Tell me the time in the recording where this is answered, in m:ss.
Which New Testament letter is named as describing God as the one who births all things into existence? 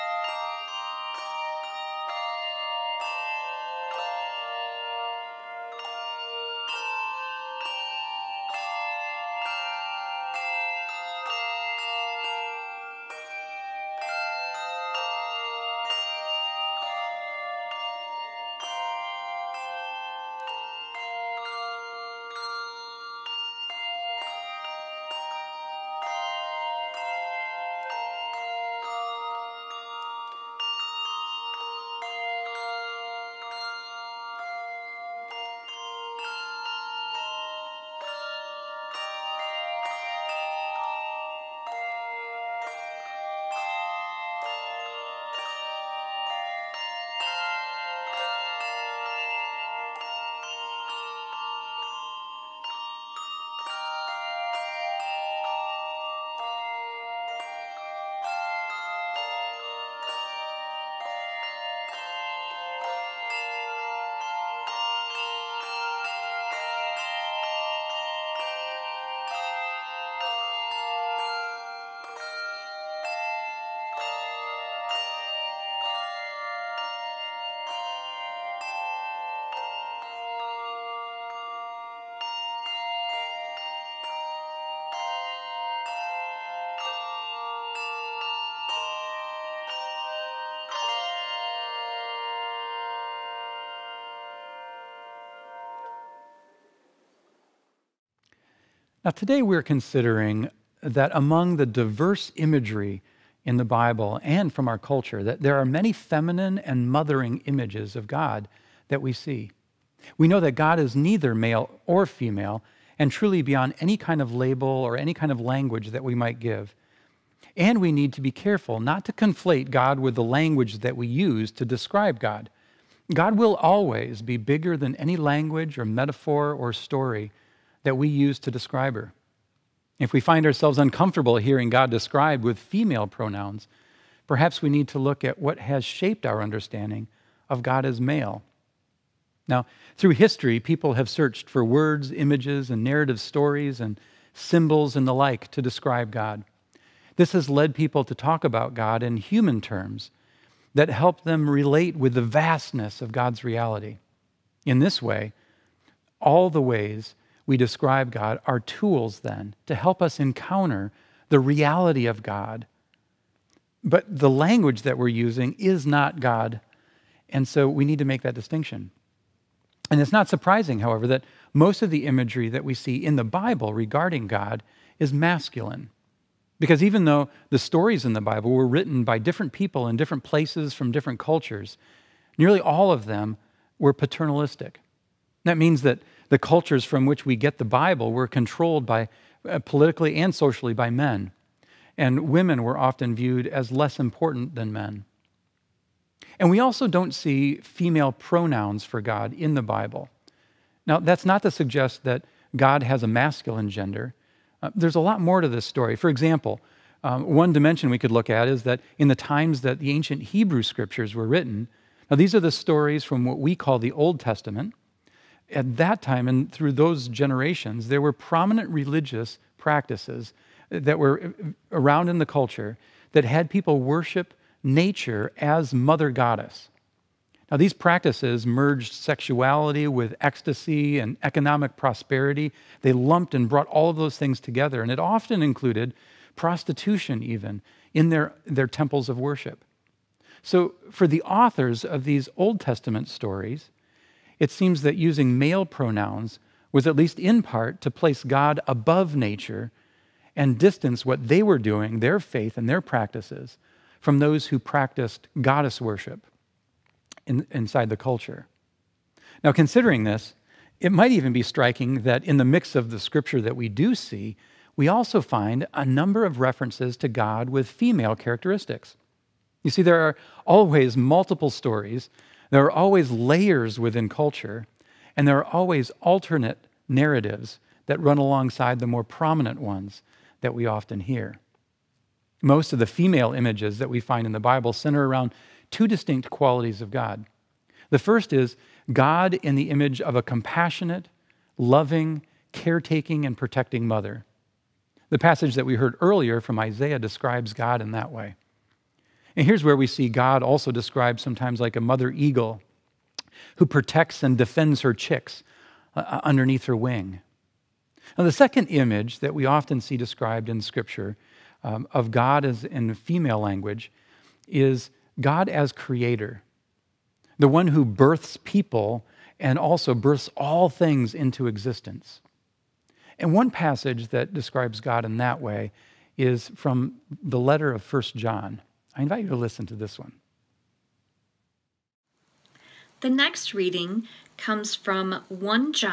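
5:27.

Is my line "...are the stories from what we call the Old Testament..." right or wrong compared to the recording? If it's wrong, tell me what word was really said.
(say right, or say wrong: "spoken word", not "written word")
right.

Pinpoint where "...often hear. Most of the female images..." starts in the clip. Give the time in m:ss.
4:40.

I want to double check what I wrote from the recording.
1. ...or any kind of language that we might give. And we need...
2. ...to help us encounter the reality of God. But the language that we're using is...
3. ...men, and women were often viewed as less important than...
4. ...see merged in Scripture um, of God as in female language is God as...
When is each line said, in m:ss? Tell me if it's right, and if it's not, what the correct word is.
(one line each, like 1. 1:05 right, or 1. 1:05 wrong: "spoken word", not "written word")
1. 1:54 right
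2. 2:39 right
3. 3:10 right
4. 5:09 wrong: "described", not "merged".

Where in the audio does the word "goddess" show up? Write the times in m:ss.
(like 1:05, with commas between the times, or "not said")
3:46, 4:15.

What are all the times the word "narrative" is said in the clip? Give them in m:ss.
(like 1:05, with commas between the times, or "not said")
2:22, 4:36.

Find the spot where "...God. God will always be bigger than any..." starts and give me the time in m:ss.
2:02.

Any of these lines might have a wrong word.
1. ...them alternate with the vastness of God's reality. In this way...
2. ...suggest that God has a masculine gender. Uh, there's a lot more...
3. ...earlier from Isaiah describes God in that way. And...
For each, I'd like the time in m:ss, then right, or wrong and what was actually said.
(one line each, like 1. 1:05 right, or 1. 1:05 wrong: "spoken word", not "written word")
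1. 2:31 wrong: "relate", not "alternate"
2. 3:21 right
3. 4:55 right.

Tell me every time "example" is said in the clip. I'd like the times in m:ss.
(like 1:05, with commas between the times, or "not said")
3:26.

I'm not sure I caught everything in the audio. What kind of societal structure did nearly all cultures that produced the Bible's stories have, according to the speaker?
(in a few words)
Paternalistic.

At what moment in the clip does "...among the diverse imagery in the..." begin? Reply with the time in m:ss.
1:41.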